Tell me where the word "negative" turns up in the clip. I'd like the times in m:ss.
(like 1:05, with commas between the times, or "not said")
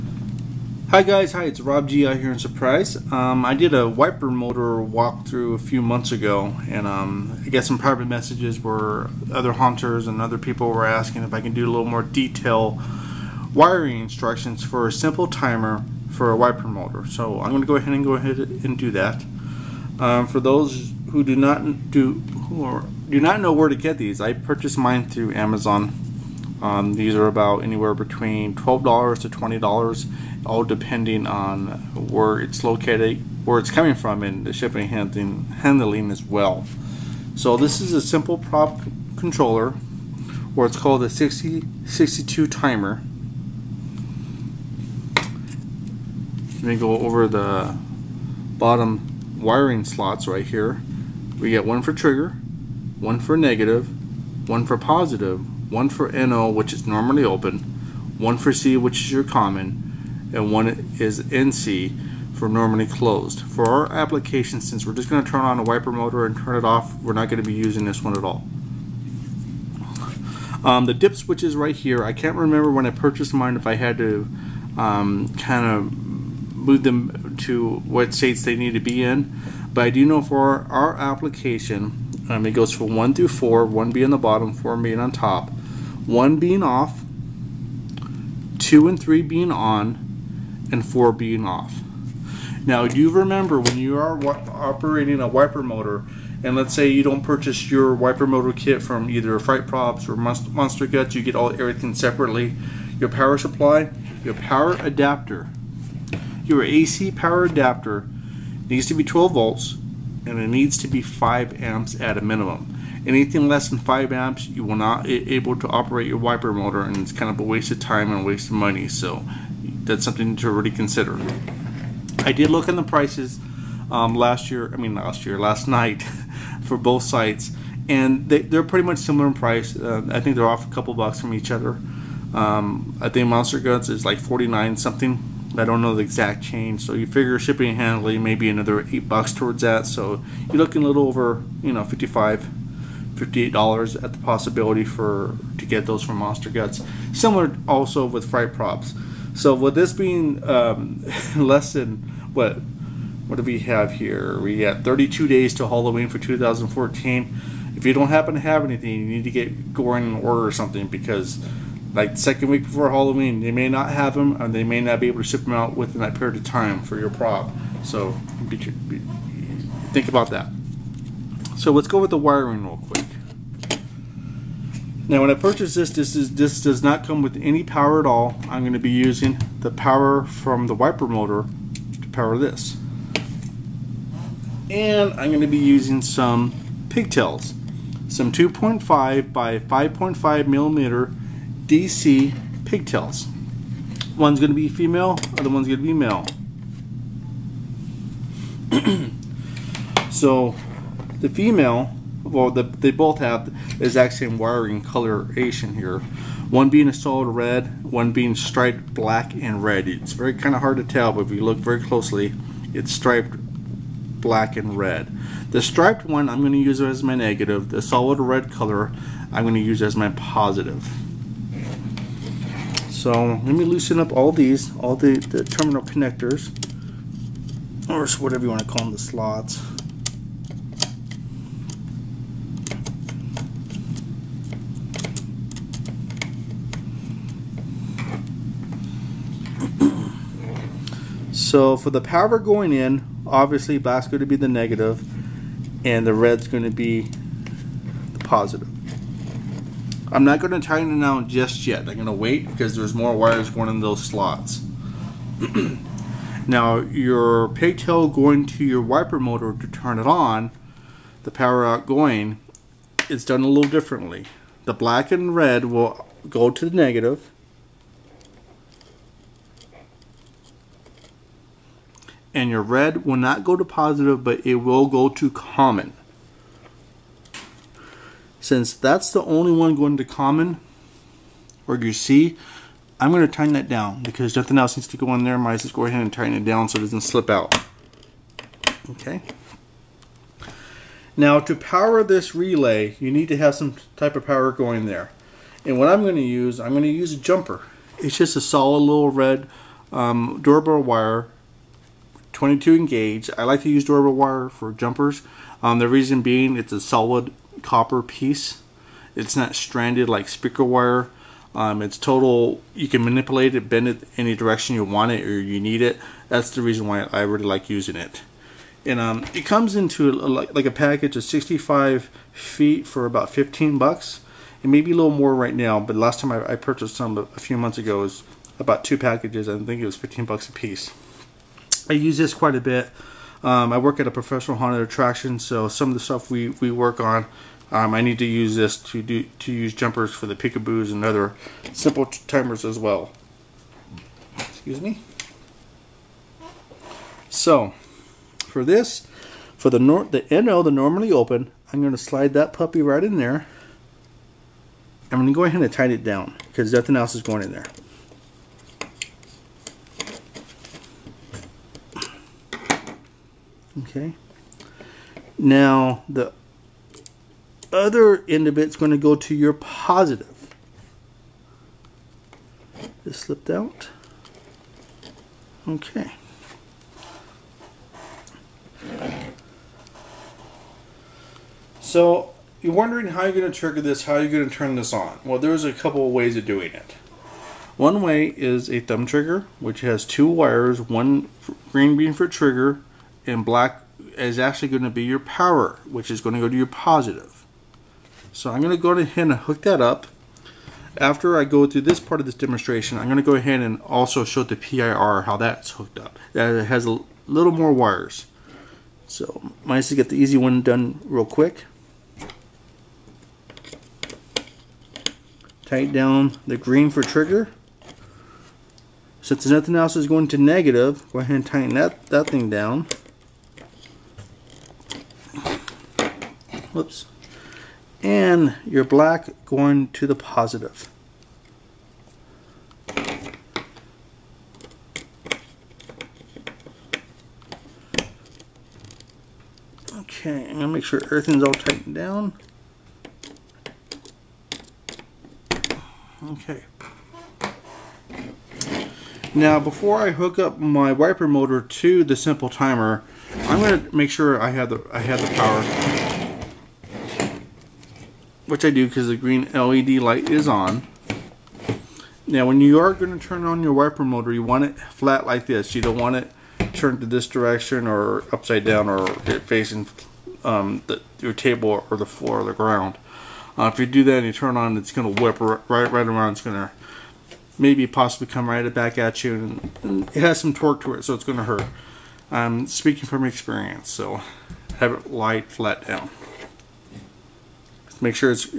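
0:53, 3:37, 4:04, 4:26, 7:00.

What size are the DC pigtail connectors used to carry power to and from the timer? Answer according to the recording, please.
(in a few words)
2.5 by 5.5 millimeter.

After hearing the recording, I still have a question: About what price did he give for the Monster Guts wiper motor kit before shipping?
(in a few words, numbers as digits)
49.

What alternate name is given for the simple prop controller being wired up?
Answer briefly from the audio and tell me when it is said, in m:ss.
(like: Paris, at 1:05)
62 timer, at 0:41.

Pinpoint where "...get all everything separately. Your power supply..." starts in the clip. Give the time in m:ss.
1:41.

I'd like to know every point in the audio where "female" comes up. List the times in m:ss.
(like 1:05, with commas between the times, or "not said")
3:14, 3:21.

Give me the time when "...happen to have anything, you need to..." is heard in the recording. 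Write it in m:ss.
2:38.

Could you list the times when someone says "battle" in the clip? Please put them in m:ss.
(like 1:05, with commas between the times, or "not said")
not said.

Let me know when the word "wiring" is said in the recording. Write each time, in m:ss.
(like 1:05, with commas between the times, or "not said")
0:13, 0:49, 2:52, 3:24.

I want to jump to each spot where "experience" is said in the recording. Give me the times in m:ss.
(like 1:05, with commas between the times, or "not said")
8:03.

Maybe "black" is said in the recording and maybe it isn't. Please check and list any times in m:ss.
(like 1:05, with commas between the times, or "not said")
3:28, 3:34, 4:03, 4:24, 6:33, 7:08.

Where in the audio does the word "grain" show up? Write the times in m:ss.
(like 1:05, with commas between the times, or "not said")
not said.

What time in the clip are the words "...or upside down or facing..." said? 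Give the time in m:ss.
7:47.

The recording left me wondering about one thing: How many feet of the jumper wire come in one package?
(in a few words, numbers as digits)
65 feet.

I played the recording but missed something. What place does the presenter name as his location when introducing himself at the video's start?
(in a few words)
Surprise.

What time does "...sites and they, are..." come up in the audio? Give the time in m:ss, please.
2:07.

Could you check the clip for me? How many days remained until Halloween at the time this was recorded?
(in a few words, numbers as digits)
32.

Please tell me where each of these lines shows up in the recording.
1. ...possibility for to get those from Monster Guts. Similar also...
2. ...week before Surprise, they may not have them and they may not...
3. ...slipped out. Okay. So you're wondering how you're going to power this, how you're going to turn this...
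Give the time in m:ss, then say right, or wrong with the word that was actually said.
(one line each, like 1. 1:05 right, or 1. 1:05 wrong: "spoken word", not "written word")
1. 2:24 right
2. 2:42 wrong: "Halloween", not "Surprise"
3. 6:13 wrong: "trigger", not "power".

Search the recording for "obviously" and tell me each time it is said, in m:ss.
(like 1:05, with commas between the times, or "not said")
4:03.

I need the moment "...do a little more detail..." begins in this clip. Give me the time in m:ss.
0:11.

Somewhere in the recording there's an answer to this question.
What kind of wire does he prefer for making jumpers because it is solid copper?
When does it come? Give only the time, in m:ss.
5:03.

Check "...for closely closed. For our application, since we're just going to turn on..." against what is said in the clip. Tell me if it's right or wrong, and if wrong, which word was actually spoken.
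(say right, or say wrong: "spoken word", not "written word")
wrong: "normally", not "closely".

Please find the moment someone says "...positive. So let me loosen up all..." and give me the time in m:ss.
3:40.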